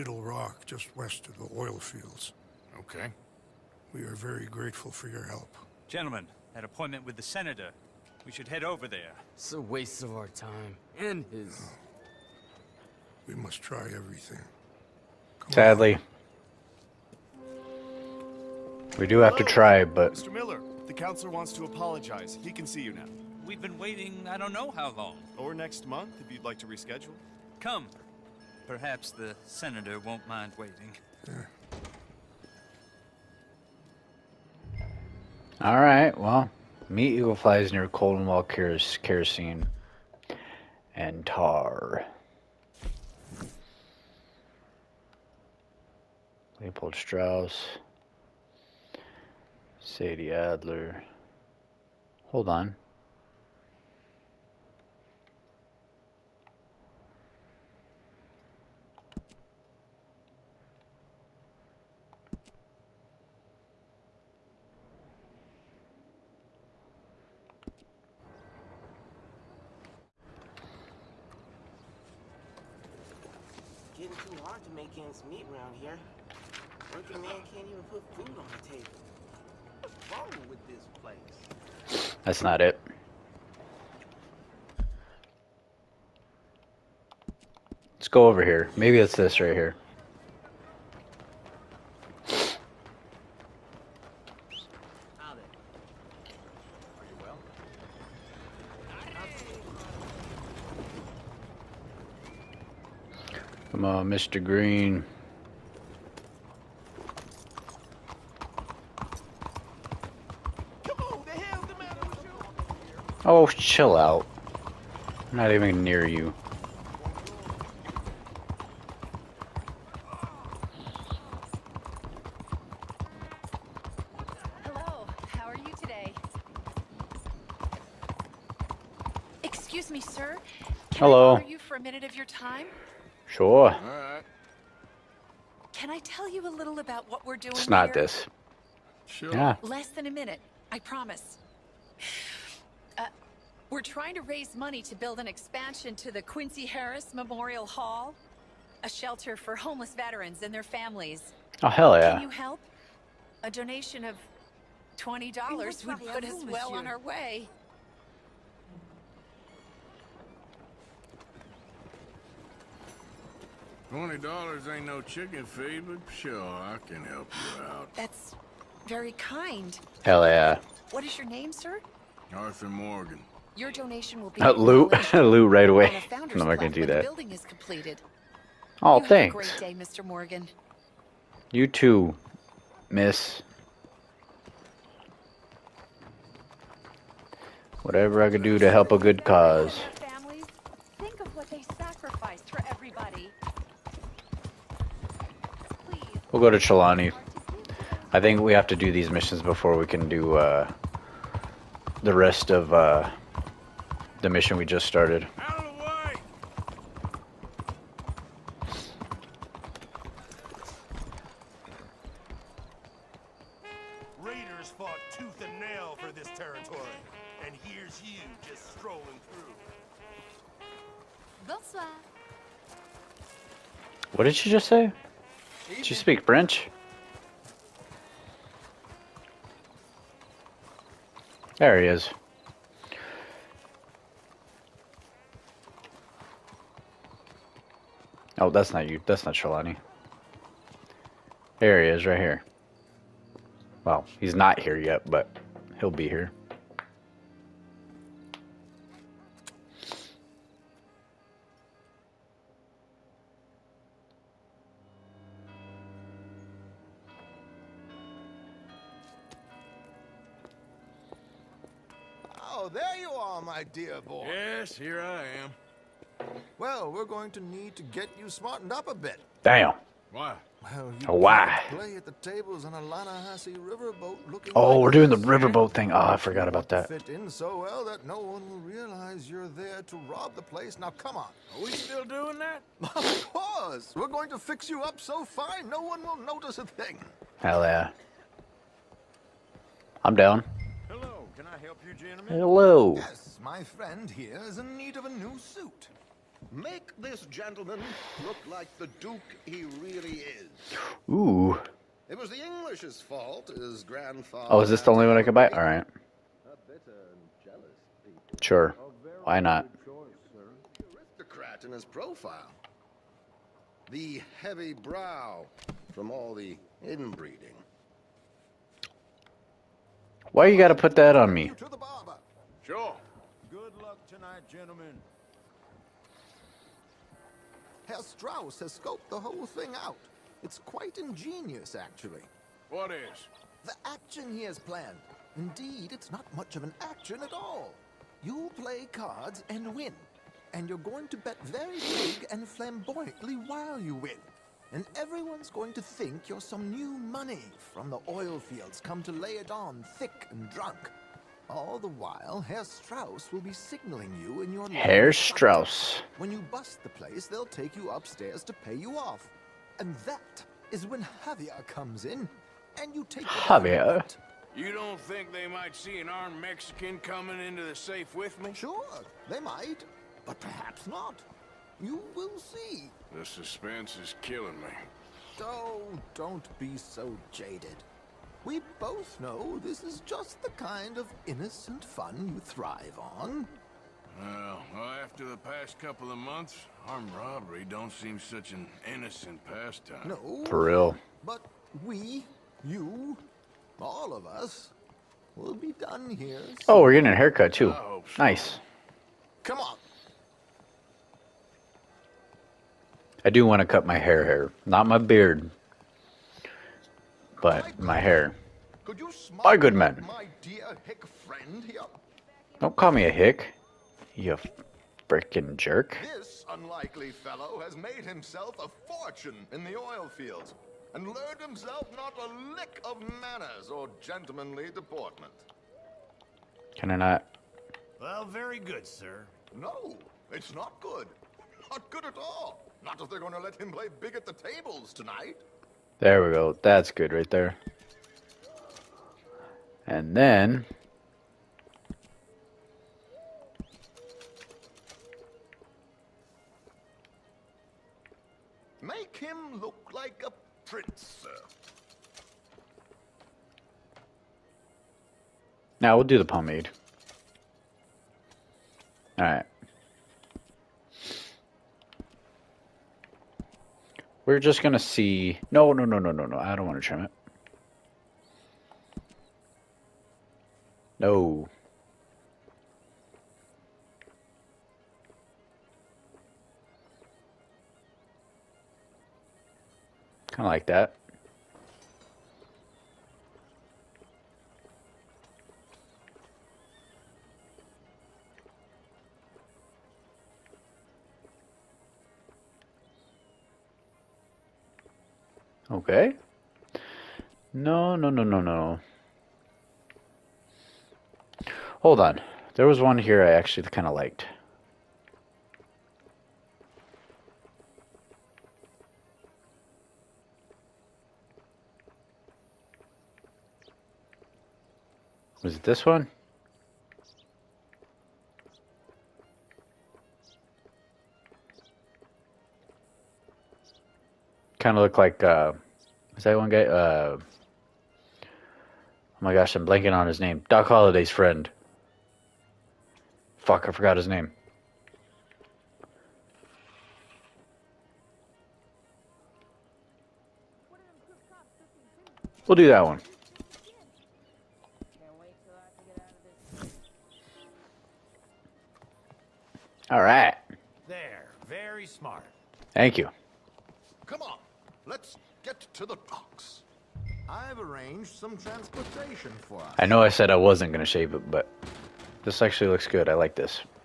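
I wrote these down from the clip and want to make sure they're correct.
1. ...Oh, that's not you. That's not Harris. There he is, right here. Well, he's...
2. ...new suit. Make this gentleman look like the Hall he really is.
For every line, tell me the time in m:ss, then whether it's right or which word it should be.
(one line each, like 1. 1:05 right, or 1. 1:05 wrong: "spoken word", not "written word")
1. 3:58 wrong: "Trelawny", not "Harris"
2. 4:55 wrong: "Duke", not "Hall".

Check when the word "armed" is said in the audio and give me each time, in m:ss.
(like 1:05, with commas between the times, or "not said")
6:06, 6:26.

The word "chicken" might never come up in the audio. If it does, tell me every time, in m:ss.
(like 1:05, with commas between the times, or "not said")
2:45.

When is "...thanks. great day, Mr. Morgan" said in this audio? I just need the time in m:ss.
2:59.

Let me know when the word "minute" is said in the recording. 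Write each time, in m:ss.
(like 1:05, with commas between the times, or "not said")
2:11, 2:20.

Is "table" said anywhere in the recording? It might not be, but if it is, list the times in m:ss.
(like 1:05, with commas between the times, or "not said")
1:18, 7:14.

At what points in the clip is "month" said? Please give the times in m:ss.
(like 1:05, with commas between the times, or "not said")
0:25, 6:26.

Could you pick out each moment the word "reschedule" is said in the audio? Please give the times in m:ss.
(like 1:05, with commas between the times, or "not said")
0:26.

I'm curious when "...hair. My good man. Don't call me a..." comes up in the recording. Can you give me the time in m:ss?
6:48.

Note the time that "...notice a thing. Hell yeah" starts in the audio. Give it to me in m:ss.
4:46.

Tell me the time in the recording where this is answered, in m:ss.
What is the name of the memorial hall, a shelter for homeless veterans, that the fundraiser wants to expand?
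2:26.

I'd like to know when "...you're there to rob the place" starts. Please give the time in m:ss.
4:39.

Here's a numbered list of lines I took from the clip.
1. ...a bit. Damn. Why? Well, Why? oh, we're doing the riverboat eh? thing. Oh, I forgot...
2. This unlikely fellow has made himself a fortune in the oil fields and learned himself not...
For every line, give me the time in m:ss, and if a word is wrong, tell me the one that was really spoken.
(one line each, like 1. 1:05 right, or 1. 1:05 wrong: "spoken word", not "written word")
1. 4:28 right
2. 6:56 right.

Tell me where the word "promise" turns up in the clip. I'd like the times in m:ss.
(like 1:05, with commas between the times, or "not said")
2:20.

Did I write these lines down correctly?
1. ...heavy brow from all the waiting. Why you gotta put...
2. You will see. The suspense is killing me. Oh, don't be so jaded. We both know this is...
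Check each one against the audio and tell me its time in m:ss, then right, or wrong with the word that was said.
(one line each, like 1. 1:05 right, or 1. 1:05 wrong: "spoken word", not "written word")
1. 5:14 wrong: "inbreeding", not "waiting"
2. 6:11 right.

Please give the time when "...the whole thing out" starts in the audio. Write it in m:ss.
5:29.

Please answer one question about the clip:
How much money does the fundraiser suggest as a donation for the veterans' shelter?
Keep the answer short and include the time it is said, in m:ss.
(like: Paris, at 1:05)
$20, at 2:34.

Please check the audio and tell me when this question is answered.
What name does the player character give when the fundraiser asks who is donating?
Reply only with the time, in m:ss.
2:52.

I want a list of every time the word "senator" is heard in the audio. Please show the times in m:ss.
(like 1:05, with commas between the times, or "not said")
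0:07, 0:29.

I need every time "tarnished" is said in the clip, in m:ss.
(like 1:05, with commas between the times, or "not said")
not said.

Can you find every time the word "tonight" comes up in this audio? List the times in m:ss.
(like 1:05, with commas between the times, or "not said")
5:24, 7:14.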